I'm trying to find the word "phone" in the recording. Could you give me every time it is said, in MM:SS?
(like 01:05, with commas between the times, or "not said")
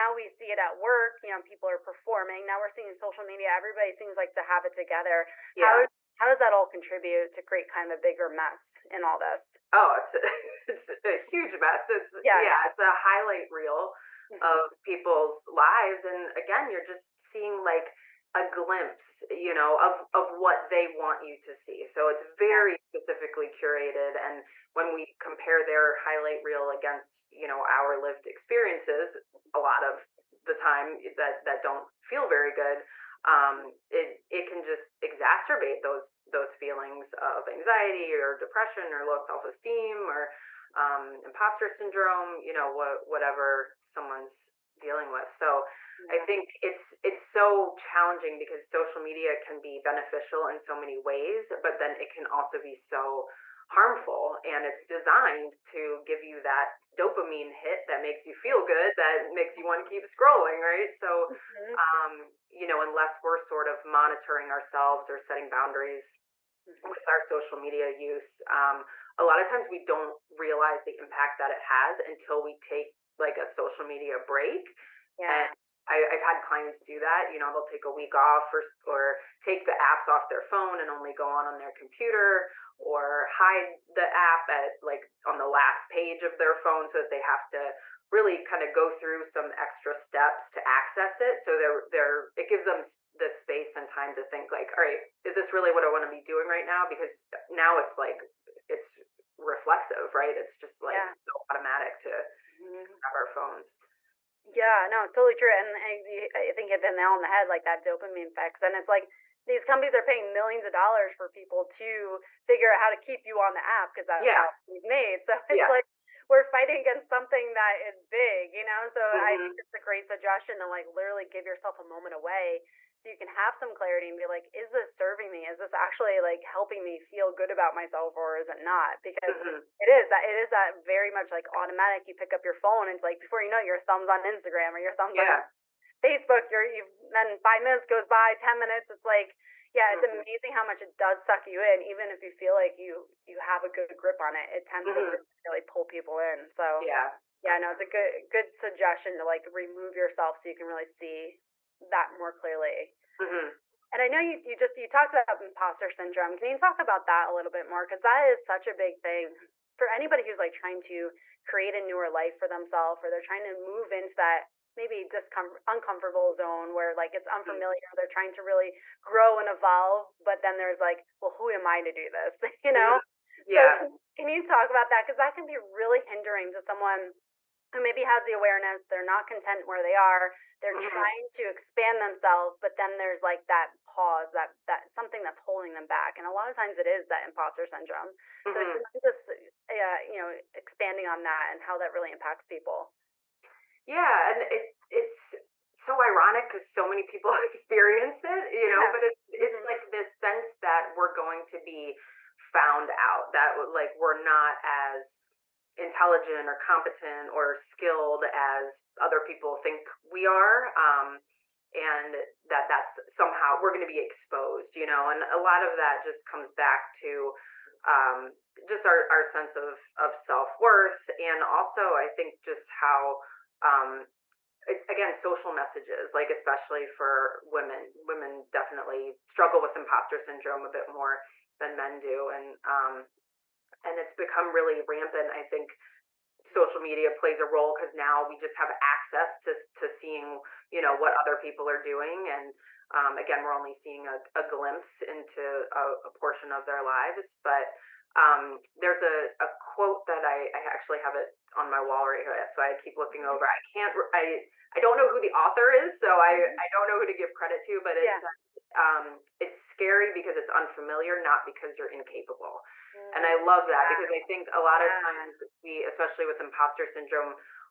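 01:20, 01:26, 01:43, 02:12.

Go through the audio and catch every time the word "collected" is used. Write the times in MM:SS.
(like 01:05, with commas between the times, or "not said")
not said.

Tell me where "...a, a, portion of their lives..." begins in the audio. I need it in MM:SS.
04:05.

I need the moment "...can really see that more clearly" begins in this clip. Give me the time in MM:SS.
02:30.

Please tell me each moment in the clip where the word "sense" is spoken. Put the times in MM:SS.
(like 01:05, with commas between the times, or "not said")
03:20, 03:39.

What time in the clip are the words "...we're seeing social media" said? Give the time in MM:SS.
00:02.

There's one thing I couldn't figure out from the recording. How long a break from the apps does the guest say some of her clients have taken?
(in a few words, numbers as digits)
a week.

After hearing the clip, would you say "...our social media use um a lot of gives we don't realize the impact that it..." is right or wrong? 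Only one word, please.
wrong.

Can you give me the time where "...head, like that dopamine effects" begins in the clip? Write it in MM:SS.
01:47.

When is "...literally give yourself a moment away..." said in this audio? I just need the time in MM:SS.
02:00.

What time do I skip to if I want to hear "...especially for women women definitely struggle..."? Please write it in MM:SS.
03:46.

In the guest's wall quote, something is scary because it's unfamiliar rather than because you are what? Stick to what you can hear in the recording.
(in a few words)
incapable.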